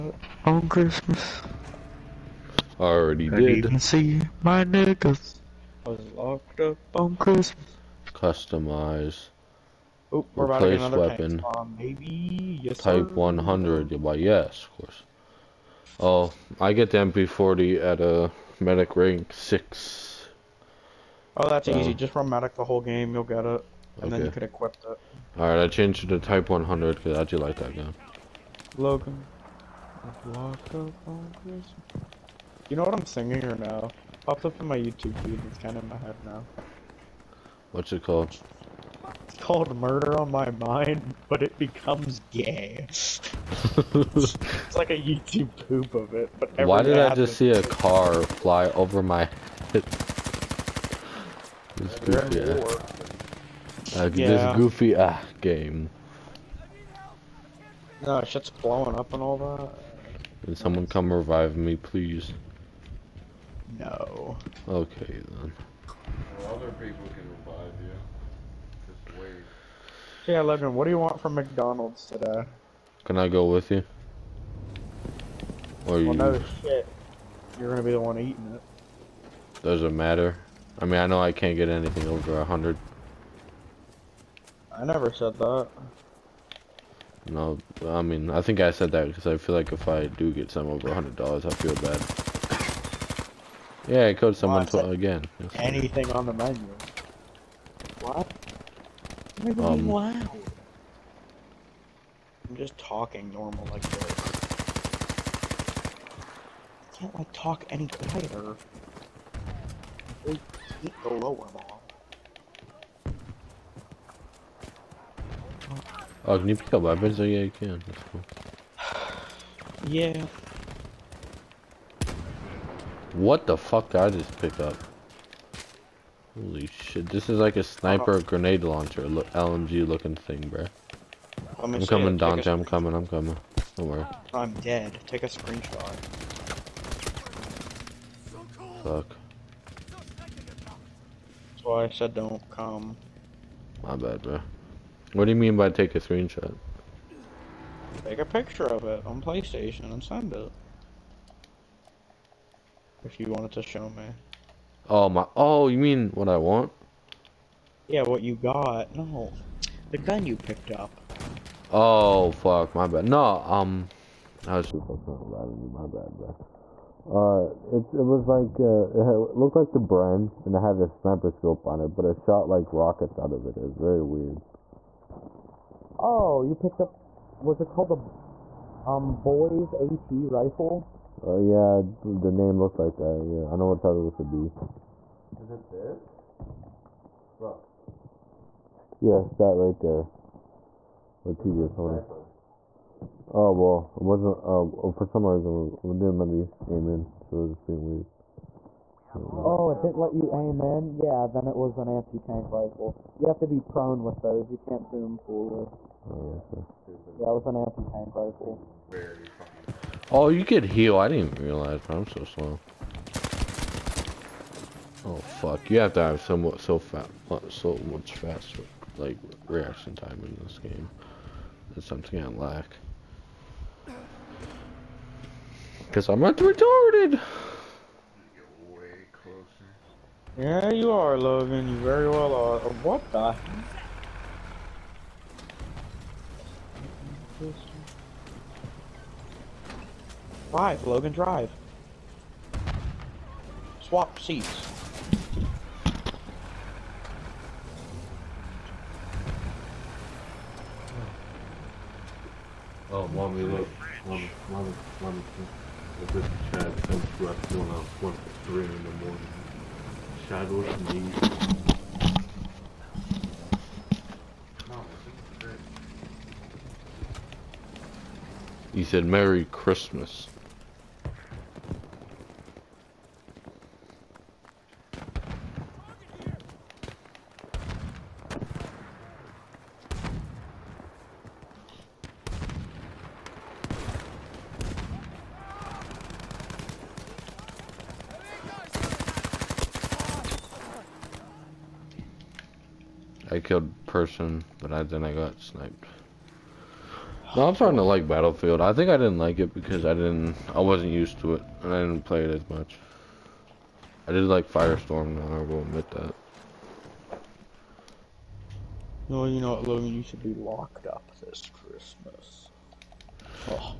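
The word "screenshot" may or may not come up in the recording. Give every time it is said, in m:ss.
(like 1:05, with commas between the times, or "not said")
2:15, 2:25.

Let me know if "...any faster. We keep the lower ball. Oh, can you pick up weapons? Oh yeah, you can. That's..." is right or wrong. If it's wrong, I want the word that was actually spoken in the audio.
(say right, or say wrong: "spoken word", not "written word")
wrong: "quieter", not "faster".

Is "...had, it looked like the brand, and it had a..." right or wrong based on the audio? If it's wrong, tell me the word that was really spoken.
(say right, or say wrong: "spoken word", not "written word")
right.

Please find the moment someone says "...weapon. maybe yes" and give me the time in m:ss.
0:10.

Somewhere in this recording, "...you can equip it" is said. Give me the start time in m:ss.
0:24.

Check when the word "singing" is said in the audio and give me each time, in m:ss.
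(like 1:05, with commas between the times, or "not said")
0:33.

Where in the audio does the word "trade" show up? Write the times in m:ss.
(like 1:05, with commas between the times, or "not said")
not said.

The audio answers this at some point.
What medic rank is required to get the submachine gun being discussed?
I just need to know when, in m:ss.
0:19.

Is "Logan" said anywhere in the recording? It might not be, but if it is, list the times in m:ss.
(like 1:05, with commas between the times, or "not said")
0:28, 3:51, 4:00, 5:09.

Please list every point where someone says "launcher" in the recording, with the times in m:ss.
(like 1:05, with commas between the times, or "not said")
2:08.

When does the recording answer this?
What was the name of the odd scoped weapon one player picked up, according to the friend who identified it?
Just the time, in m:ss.
2:59.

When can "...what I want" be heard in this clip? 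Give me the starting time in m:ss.
2:36.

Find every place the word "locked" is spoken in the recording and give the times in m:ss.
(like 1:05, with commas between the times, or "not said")
0:06, 5:10.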